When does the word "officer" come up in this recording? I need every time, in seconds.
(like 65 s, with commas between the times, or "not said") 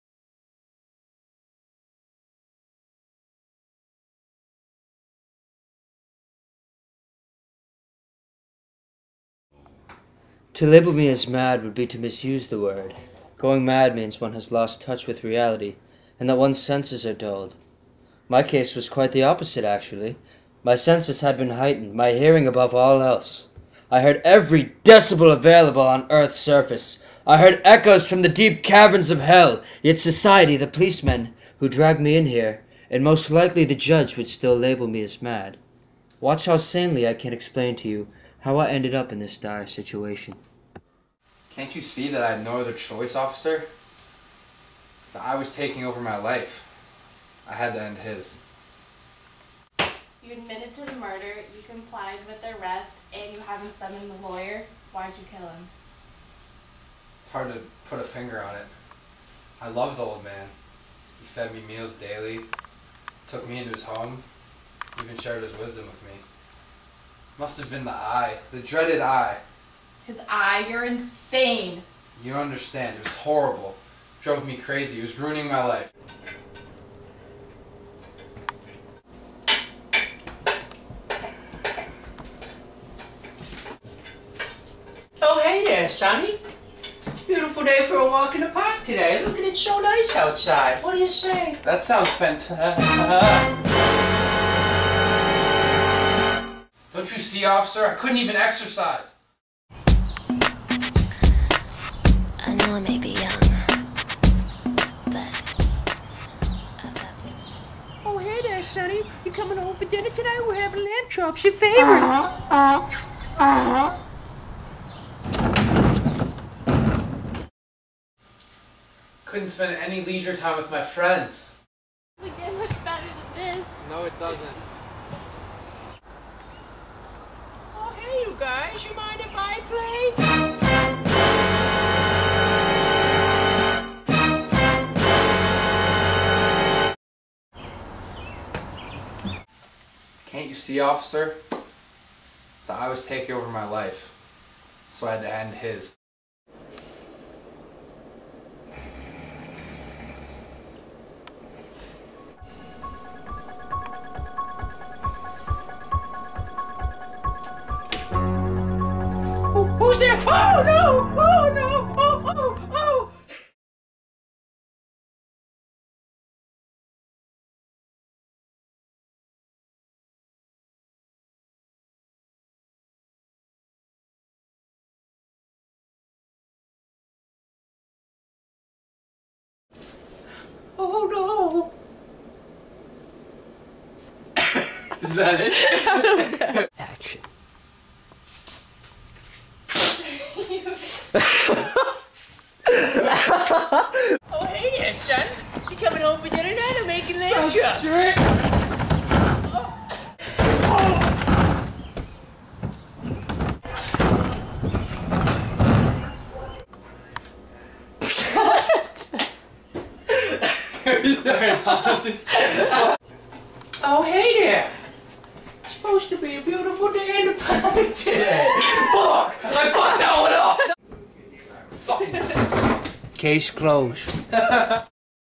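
43 s, 97 s, 140 s.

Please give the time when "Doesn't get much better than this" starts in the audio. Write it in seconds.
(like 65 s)
122 s.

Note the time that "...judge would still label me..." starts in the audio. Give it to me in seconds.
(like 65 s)
33 s.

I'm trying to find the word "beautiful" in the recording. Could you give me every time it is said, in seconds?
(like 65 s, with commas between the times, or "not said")
87 s, 216 s.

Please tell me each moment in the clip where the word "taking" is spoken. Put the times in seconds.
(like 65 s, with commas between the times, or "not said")
45 s, 143 s.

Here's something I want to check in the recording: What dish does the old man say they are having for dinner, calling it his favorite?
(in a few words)
Lamb chops.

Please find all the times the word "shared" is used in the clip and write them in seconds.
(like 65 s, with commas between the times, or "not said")
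65 s.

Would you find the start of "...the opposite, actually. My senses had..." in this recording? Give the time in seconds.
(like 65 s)
19 s.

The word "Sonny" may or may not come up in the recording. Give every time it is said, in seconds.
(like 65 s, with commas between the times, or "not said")
85 s, 108 s.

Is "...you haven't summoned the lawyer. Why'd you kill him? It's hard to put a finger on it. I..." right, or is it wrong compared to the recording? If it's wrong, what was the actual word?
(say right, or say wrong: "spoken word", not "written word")
right.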